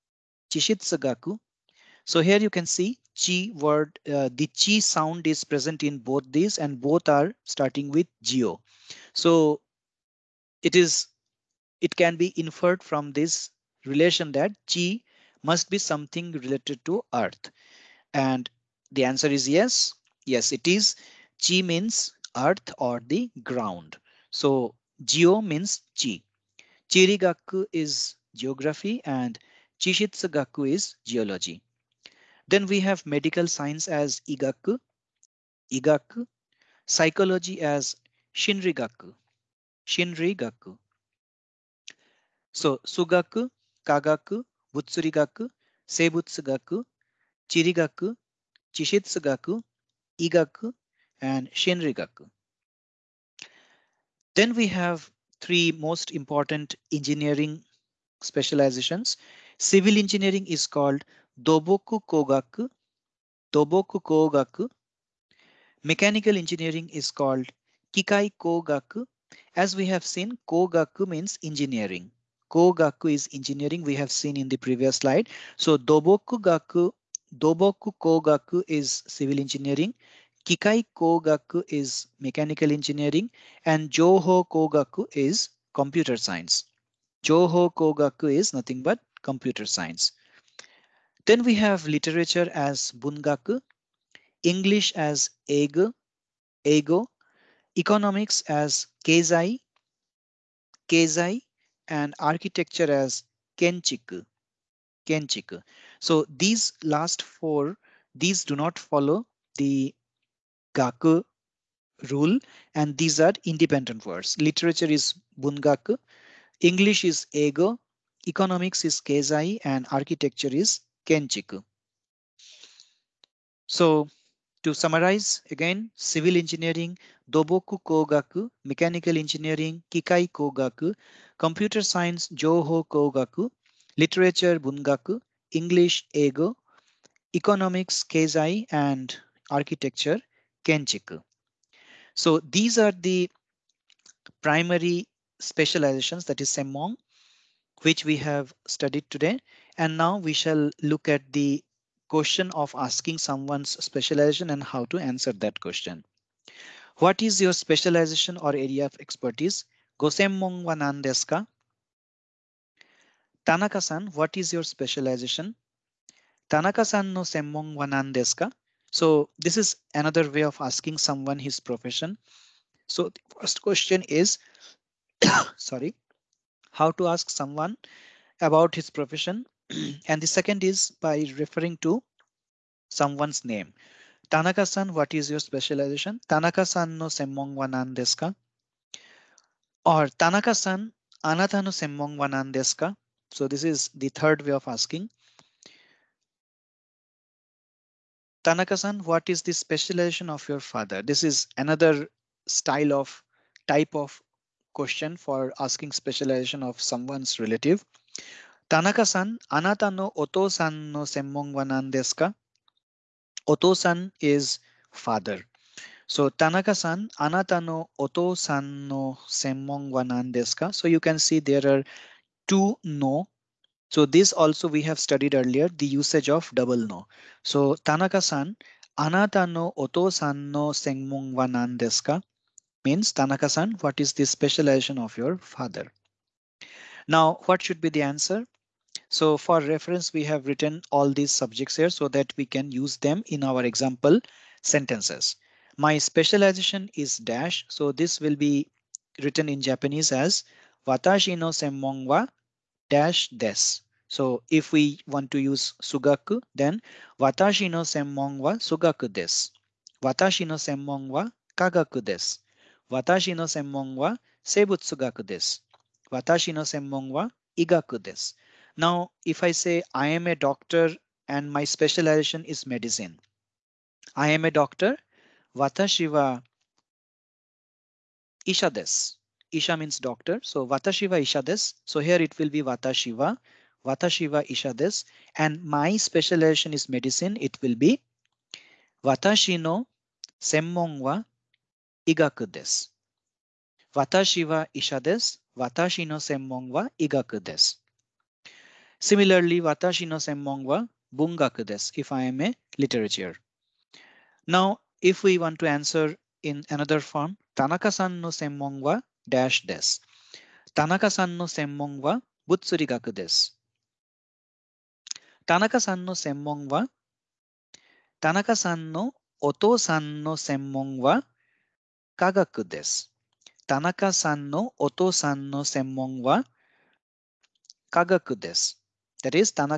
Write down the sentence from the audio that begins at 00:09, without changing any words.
So it is, it can be inferred from this relation that chi must be something related to earth.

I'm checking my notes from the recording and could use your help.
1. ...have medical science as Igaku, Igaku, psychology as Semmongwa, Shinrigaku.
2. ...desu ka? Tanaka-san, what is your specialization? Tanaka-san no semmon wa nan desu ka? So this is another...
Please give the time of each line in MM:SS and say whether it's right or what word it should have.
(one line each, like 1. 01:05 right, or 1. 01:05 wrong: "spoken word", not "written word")
1. 00:32 wrong: "Shinrigaku", not "Semmongwa"
2. 02:41 right.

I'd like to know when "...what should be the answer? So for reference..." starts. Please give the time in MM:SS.
03:57.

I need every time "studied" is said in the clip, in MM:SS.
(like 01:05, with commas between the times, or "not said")
02:28, 03:44.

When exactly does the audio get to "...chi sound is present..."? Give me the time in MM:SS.
00:04.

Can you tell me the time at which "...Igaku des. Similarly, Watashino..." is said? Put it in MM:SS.
04:57.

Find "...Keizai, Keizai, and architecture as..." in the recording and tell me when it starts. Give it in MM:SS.
01:39.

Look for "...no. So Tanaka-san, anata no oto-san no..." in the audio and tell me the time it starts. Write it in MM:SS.
03:46.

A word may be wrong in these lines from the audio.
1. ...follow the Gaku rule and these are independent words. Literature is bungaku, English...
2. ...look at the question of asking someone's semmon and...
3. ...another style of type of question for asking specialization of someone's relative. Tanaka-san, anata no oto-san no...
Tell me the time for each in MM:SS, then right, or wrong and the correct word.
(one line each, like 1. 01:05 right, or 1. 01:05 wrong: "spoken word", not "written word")
1. 01:48 right
2. 02:30 wrong: "specialization", not "semmon"
3. 03:21 right.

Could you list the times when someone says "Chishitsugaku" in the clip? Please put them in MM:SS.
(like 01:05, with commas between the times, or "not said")
00:00, 00:29, 00:48.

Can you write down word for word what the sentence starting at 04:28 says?
Now, if I say I am a doctor and my specialization is medicine.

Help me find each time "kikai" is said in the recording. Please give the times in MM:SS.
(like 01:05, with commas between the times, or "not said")
01:07, 01:20, 02:09.